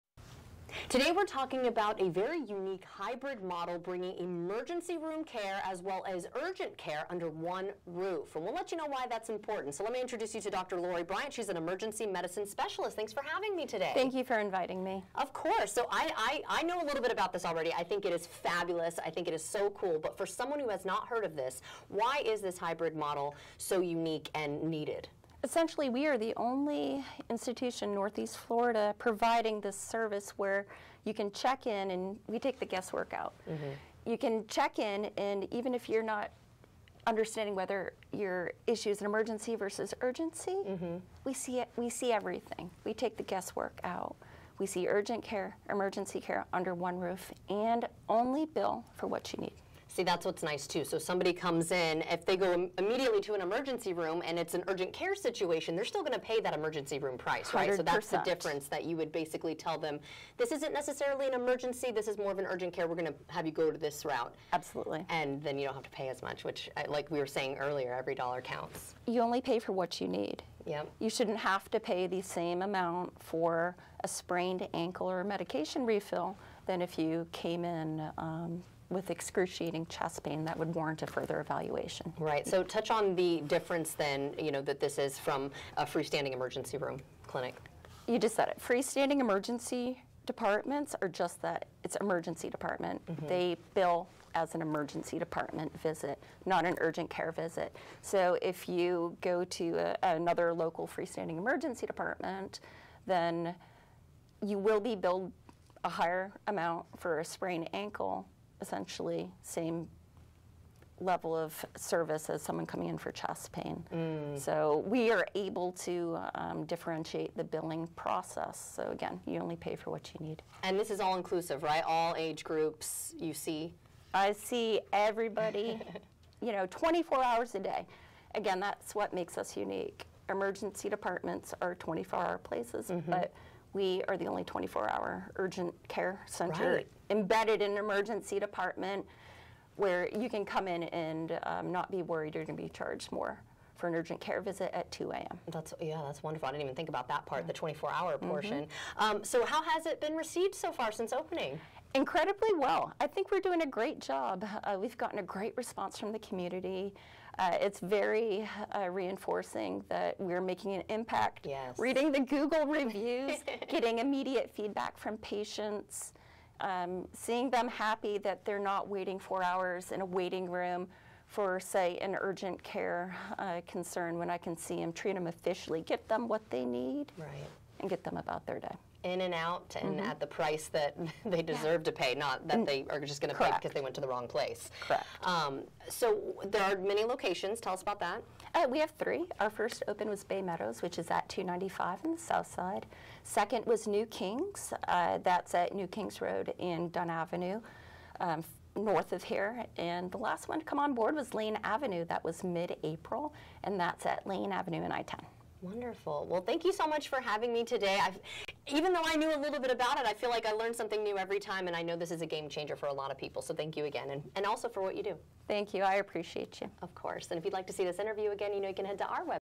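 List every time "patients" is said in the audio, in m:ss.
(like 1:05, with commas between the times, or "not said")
2:45.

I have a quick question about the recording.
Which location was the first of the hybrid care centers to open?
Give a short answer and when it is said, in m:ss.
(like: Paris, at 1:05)
Bay Meadows, at 3:10.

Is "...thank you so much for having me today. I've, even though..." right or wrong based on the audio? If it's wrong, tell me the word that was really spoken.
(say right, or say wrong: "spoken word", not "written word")
right.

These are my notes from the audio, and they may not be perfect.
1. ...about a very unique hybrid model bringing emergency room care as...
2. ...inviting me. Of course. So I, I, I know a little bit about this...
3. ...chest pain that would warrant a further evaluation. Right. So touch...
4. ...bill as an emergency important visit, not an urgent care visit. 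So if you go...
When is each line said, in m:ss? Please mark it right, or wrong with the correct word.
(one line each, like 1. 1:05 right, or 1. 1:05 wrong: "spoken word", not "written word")
1. 0:01 right
2. 0:14 right
3. 1:19 right
4. 1:33 wrong: "department", not "important".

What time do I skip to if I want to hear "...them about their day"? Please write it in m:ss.
2:58.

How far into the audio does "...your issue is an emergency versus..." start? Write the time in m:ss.
0:38.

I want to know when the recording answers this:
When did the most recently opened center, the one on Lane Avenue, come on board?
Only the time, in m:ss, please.
3:22.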